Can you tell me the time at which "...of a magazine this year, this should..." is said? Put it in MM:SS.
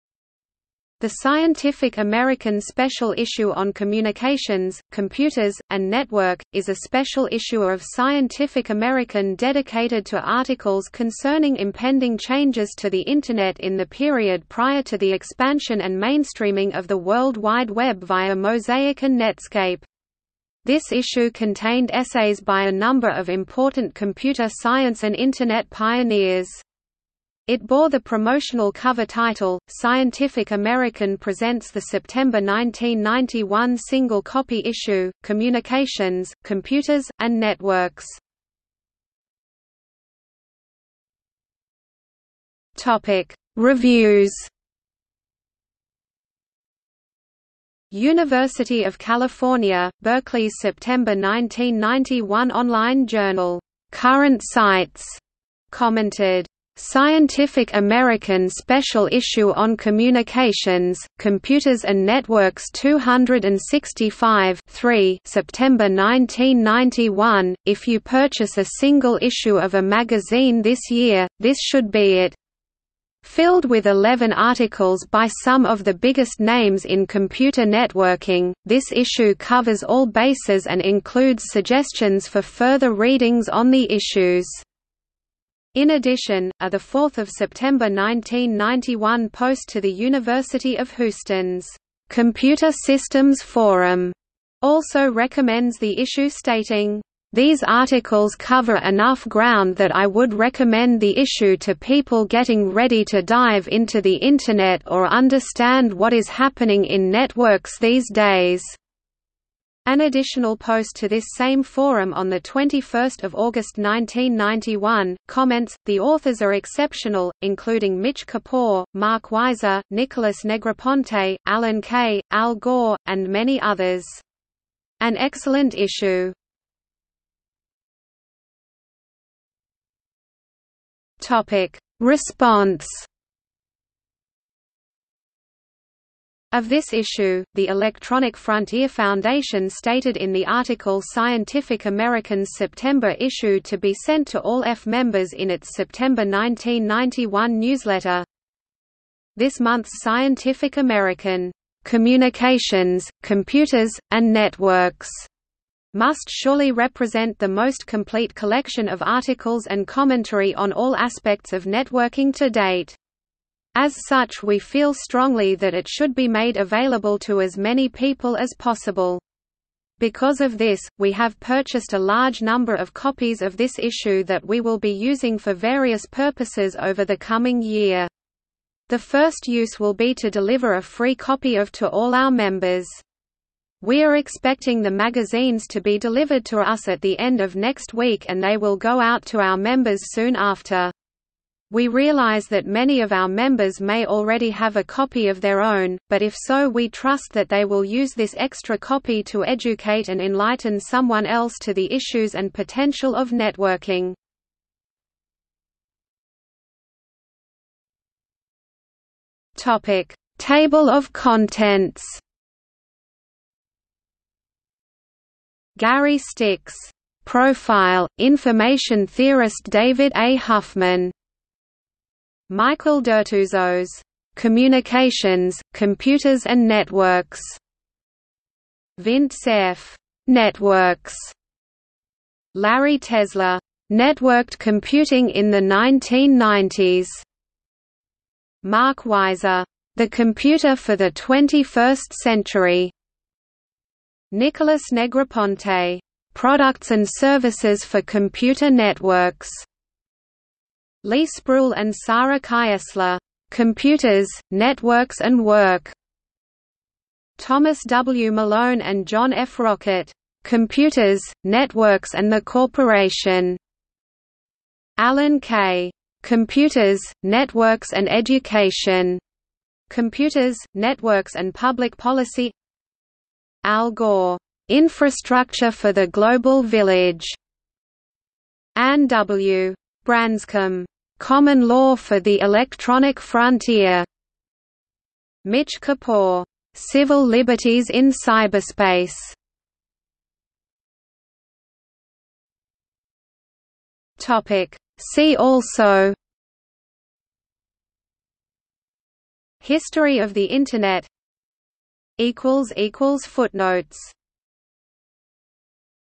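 01:09.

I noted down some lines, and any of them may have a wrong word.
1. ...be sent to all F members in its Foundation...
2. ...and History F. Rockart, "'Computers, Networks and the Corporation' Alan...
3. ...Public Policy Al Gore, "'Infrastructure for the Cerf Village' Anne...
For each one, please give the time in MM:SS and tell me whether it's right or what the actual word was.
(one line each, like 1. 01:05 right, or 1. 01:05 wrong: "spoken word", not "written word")
1. 02:23 wrong: "September", not "Foundation"
2. 04:18 wrong: "John", not "History"
3. 04:31 wrong: "Global", not "Cerf".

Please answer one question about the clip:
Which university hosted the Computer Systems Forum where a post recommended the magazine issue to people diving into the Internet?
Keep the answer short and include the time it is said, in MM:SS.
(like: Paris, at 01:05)
University of Houston, at 01:29.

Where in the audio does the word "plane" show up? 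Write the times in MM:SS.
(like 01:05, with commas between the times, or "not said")
not said.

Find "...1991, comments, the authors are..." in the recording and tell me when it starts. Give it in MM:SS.
01:53.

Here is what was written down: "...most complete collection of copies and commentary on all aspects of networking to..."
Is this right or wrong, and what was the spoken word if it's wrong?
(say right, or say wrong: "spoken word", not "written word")
wrong: "articles", not "copies".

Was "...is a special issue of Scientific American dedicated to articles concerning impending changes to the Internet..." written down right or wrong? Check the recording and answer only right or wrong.
right.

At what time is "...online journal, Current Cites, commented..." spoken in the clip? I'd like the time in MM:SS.
00:52.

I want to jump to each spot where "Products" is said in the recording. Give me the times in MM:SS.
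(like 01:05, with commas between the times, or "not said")
04:06.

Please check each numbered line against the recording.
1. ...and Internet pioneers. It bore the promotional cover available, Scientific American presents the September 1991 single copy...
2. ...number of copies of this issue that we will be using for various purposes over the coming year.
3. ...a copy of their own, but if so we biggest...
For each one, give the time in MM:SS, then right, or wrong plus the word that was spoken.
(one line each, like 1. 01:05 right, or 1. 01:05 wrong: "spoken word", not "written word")
1. 00:25 wrong: "title", not "available"
2. 02:52 right
3. 03:14 wrong: "trust", not "biggest".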